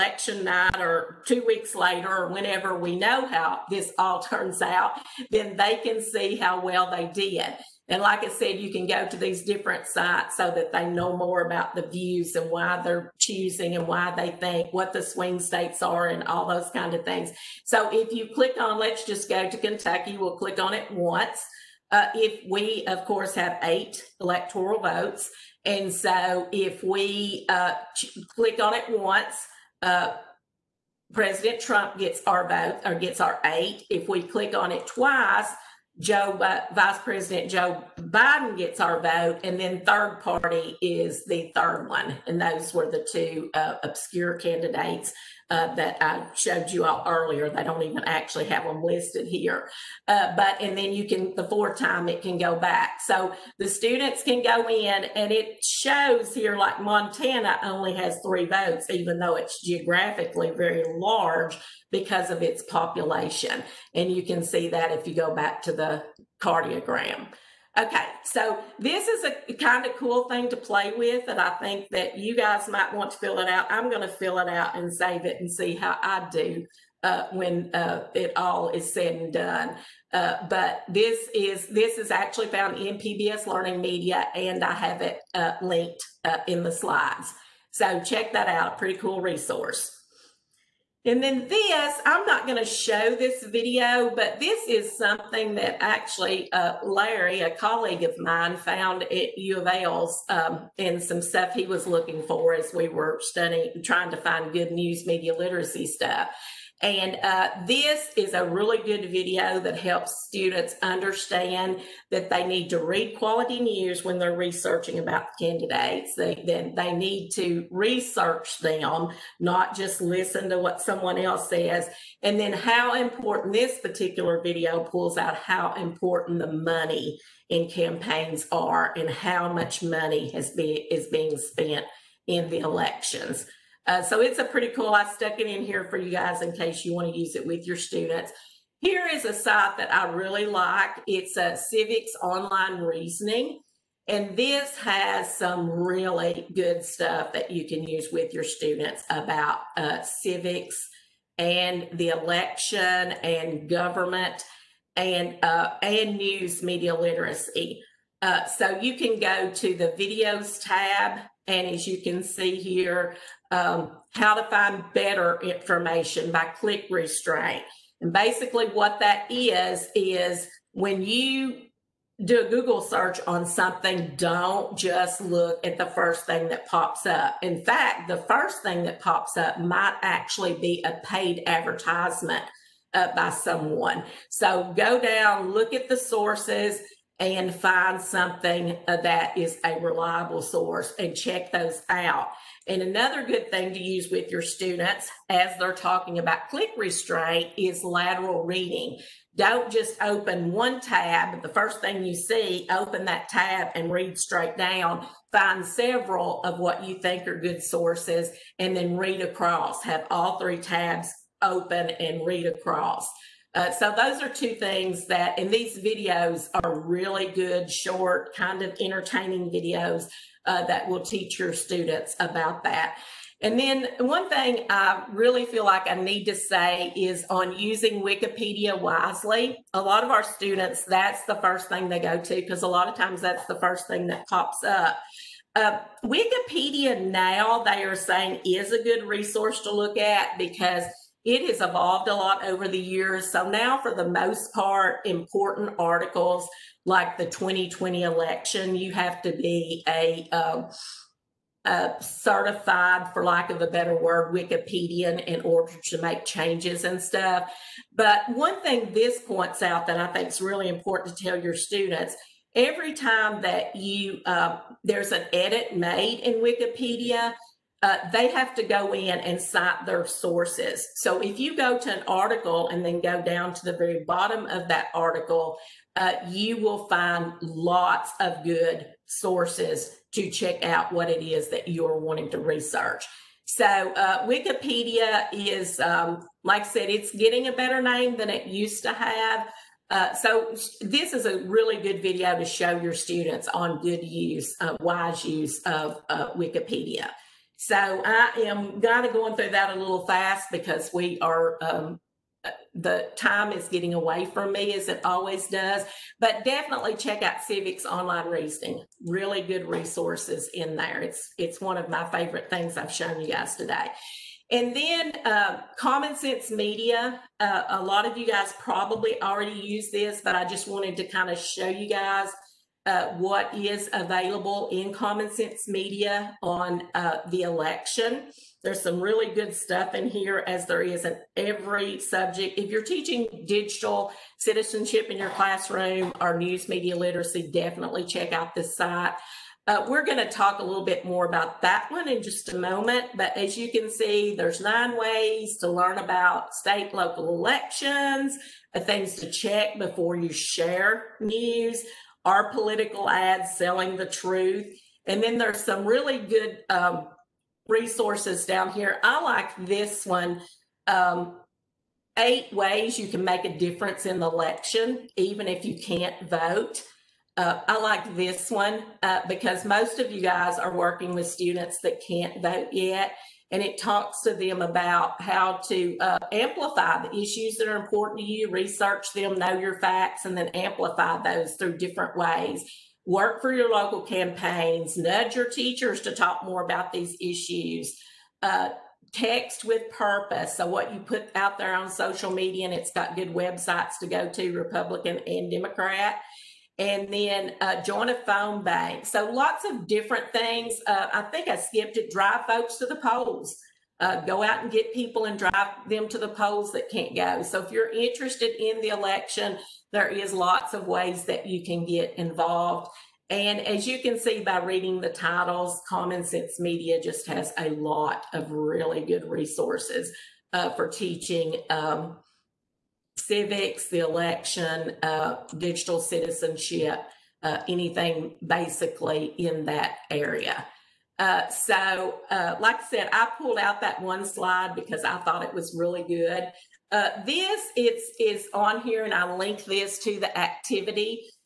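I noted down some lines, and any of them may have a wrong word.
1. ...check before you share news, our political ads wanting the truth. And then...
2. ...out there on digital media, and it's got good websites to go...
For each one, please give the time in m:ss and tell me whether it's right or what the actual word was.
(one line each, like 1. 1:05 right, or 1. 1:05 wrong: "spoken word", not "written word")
1. 5:49 wrong: "selling", not "wanting"
2. 6:31 wrong: "social", not "digital".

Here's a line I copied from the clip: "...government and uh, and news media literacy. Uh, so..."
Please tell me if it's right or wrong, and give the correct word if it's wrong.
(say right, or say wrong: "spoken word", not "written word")
right.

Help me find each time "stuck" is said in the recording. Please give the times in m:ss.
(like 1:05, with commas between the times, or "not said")
2:15.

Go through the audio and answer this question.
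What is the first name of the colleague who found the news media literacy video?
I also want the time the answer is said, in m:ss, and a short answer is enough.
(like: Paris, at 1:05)
Larry, at 1:36.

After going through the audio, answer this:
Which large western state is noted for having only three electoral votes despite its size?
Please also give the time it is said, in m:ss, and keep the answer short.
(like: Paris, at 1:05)
Montana, at 0:56.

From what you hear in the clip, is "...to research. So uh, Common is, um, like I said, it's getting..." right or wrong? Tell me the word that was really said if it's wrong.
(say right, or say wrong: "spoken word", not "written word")
wrong: "Wikipedia", not "Common".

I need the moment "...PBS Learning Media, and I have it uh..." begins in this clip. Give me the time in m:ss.
1:22.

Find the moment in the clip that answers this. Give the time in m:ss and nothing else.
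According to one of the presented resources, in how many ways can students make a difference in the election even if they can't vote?
6:02.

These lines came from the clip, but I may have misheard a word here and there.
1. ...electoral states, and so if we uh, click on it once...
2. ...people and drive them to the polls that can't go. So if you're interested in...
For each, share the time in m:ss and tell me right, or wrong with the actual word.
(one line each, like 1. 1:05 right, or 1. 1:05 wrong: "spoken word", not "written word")
1. 0:24 wrong: "votes", not "states"
2. 6:44 right.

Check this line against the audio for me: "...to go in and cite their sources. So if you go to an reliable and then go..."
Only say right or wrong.
wrong.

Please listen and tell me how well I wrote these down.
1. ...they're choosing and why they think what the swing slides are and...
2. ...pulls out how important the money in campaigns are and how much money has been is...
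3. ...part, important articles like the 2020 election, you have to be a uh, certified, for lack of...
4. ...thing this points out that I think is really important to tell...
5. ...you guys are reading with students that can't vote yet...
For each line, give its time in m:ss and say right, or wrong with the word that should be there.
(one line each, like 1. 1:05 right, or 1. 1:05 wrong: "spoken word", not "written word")
1. 0:12 wrong: "states", not "slides"
2. 2:04 right
3. 4:04 right
4. 4:18 right
5. 6:10 wrong: "working", not "reading".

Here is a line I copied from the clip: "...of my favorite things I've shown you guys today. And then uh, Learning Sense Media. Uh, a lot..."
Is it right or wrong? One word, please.
wrong.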